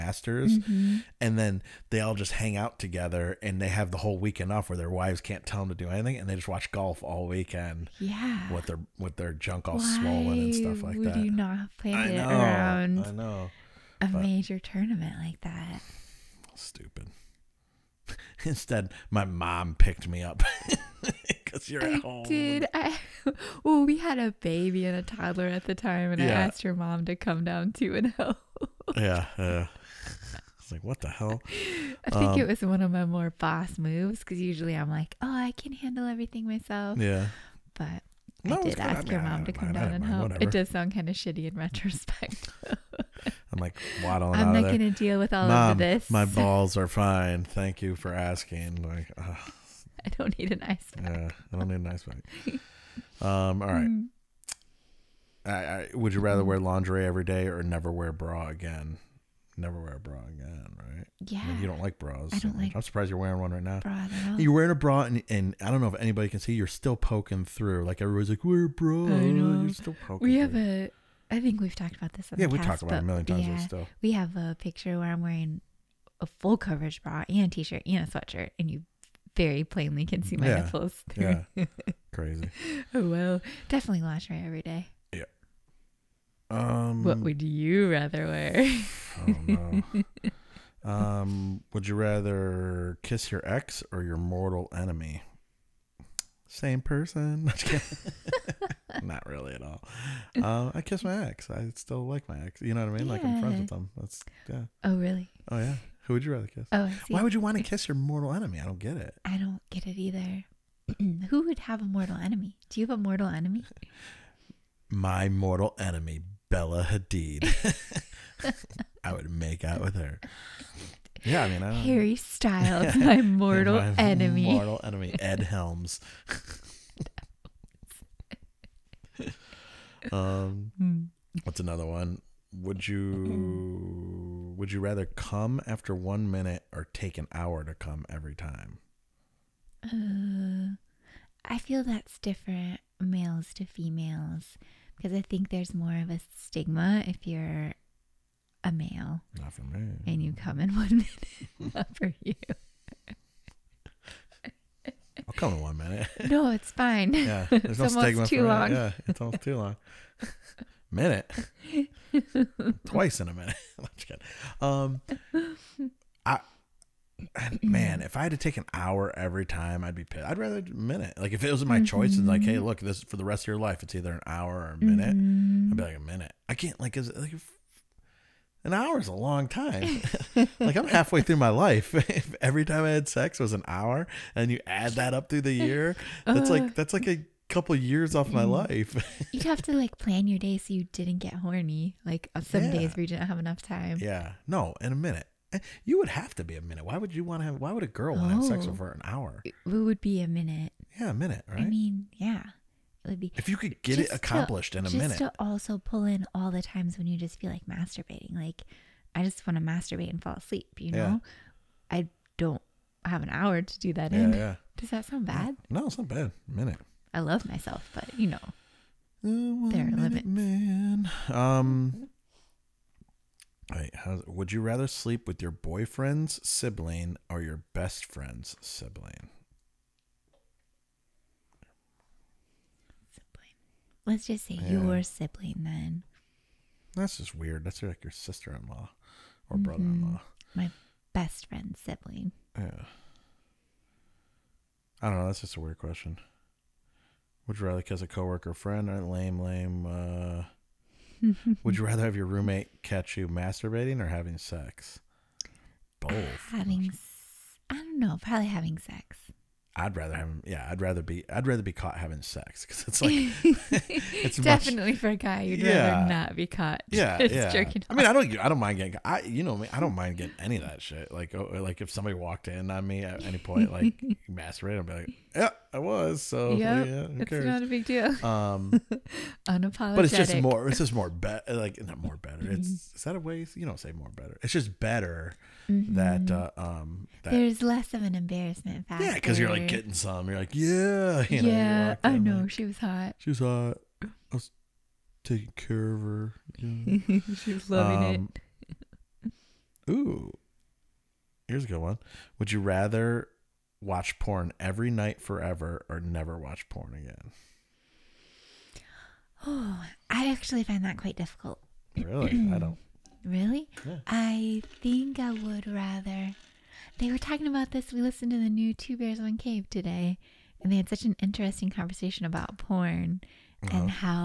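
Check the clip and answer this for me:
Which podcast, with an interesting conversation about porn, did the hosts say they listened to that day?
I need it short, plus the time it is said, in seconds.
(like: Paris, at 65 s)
Two Bears One Cave, at 318 s.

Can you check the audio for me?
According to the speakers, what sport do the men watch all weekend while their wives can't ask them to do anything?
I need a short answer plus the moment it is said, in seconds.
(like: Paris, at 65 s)
Golf, at 6 s.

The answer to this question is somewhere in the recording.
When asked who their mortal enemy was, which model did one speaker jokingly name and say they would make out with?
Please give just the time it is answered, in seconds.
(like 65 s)
116 s.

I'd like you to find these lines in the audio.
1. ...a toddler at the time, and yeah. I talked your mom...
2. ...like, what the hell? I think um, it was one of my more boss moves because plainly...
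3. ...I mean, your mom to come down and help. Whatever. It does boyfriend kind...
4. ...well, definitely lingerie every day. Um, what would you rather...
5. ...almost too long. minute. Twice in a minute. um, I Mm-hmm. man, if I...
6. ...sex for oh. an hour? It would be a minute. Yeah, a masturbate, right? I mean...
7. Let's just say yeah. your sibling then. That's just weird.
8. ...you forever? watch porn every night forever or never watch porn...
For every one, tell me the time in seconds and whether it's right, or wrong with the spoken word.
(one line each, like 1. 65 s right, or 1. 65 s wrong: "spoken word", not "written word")
1. 24 s wrong: "asked", not "talked"
2. 30 s wrong: "usually", not "plainly"
3. 38 s wrong: "sound", not "boyfriend"
4. 83 s right
5. 159 s right
6. 198 s wrong: "minute", not "masturbate"
7. 234 s right
8. 302 s wrong: "rather", not "forever".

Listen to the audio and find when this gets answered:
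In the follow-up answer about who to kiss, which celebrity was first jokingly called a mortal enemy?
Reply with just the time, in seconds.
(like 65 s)
121 s.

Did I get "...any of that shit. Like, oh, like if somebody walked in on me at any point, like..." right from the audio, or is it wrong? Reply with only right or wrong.
right.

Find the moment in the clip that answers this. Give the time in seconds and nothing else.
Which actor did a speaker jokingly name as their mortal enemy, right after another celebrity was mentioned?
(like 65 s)
125 s.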